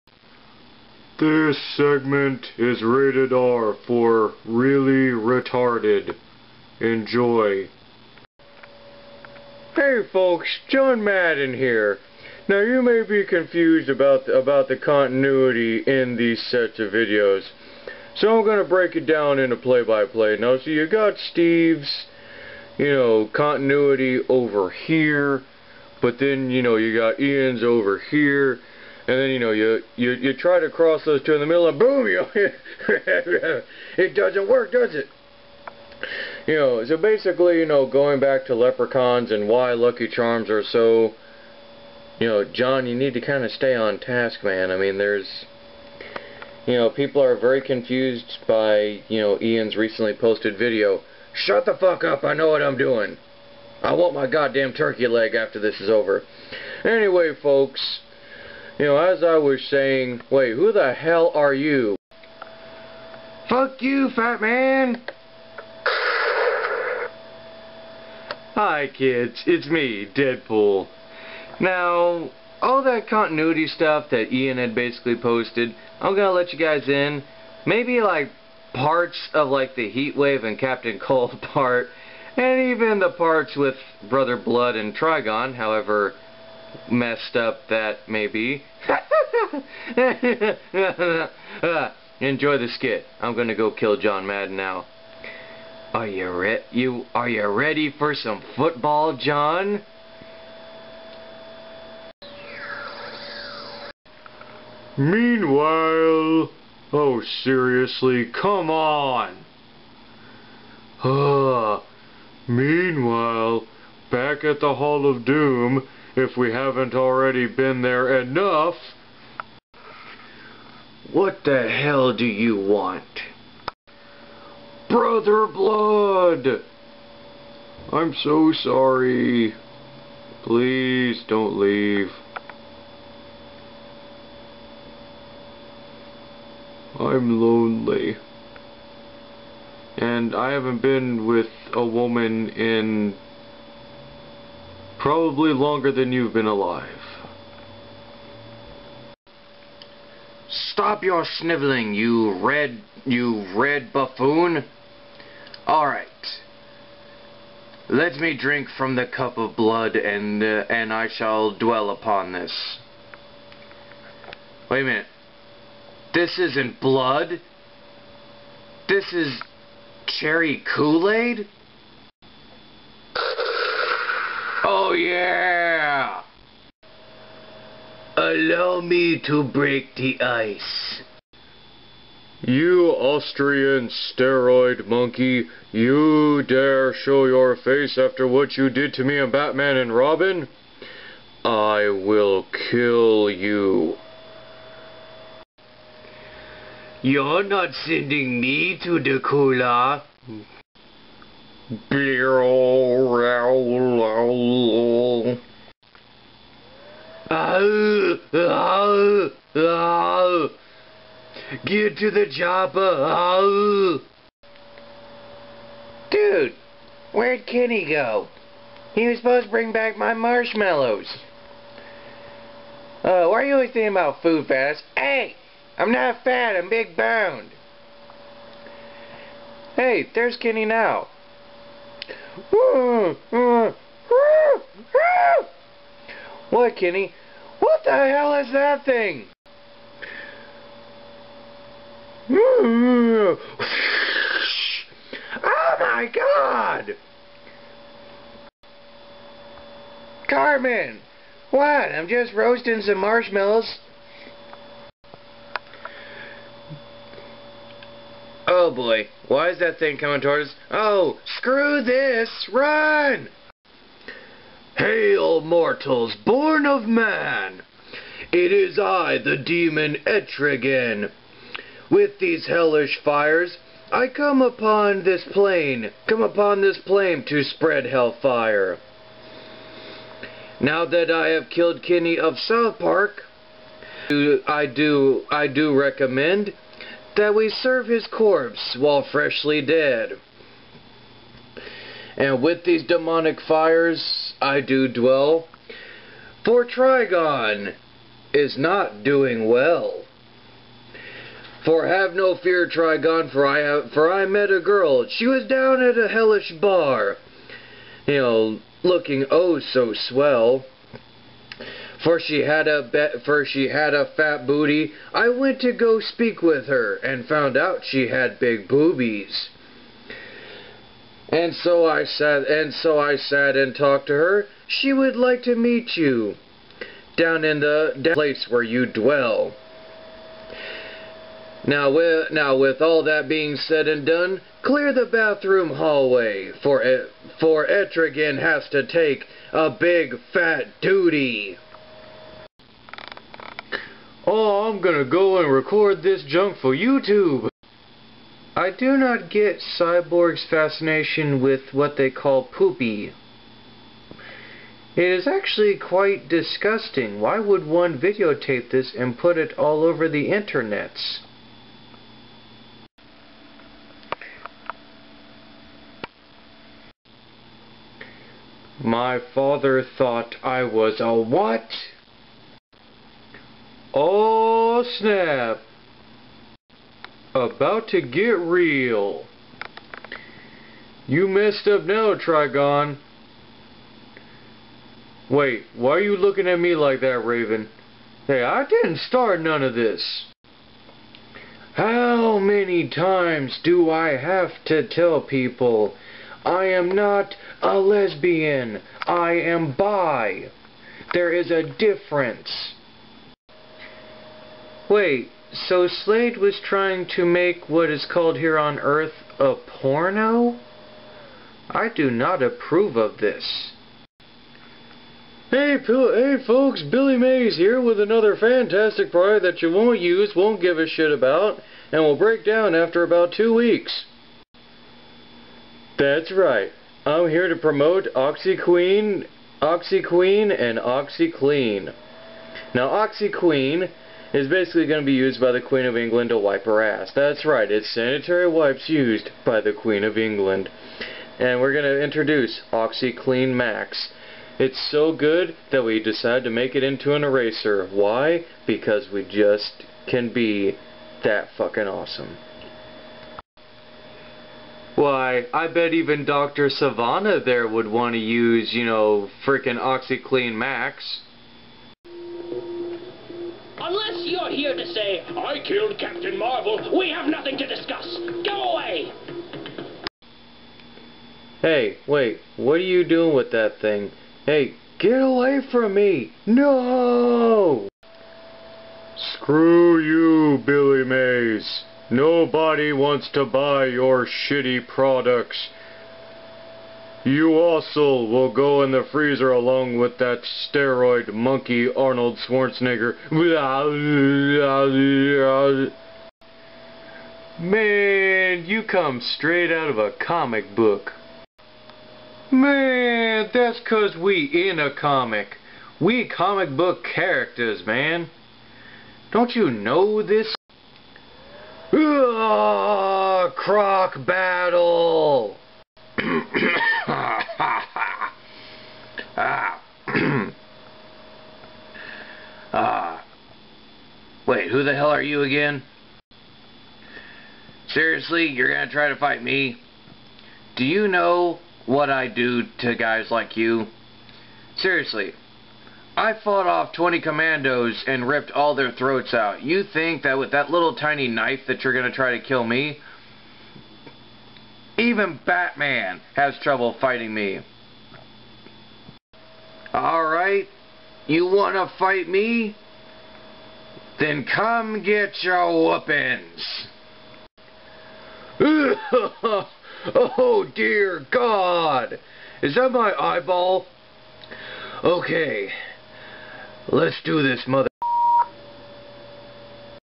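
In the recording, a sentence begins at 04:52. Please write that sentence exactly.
And with these demonic fires I do dwell, for Trigon is not doing well.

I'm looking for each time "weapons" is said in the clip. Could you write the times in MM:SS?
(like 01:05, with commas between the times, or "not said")
09:15.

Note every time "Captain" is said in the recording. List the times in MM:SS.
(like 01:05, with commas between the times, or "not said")
01:20, 07:45.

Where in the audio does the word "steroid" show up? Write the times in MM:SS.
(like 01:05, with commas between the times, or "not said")
03:03, 08:10.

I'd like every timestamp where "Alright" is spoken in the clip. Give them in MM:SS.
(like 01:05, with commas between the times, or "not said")
02:35, 09:09.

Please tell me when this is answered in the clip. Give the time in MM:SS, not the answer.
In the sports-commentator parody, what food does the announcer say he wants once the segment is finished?
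00:54.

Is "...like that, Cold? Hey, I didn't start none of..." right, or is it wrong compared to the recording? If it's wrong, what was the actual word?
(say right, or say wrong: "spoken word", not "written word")
wrong: "Raven", not "Cold".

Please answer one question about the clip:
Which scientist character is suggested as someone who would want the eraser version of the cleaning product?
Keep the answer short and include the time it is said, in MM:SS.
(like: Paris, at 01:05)
Dr. Sivana, at 07:36.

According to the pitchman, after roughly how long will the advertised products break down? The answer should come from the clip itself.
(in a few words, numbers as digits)
2 weeks.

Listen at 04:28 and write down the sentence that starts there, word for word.
It is I, the demon Etrigan.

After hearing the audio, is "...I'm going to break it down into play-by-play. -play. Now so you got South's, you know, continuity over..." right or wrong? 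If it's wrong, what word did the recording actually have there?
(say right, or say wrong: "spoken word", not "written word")
wrong: "Steve", not "South".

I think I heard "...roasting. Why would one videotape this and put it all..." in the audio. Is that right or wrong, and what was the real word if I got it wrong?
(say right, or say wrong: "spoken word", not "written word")
wrong: "disgusting", not "roasting".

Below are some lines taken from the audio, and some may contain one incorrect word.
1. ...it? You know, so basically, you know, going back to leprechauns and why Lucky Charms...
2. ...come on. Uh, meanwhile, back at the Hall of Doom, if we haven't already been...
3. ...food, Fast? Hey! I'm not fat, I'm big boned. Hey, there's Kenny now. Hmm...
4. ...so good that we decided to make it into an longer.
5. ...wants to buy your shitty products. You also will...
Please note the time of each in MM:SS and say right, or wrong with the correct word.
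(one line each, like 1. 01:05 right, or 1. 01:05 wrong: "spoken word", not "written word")
1. 00:34 right
2. 01:48 right
3. 03:44 right
4. 07:24 wrong: "eraser", not "longer"
5. 08:02 right.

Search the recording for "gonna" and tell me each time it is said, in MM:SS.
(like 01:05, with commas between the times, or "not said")
01:16, 01:33, 05:44, 08:48, 09:01.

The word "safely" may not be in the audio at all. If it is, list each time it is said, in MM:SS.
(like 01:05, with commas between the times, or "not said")
not said.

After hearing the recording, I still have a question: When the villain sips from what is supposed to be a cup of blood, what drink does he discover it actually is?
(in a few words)
Cherry Kool-Aid.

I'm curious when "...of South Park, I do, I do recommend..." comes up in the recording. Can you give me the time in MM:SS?
04:42.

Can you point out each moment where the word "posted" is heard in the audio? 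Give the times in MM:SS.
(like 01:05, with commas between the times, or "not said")
00:50, 01:15.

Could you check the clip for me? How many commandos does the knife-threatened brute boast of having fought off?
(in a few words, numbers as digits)
20.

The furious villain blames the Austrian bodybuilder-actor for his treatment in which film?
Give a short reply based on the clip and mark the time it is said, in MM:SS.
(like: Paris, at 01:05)
Batman and Robin, at 03:09.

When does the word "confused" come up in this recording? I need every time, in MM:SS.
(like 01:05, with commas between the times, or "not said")
00:13, 00:47.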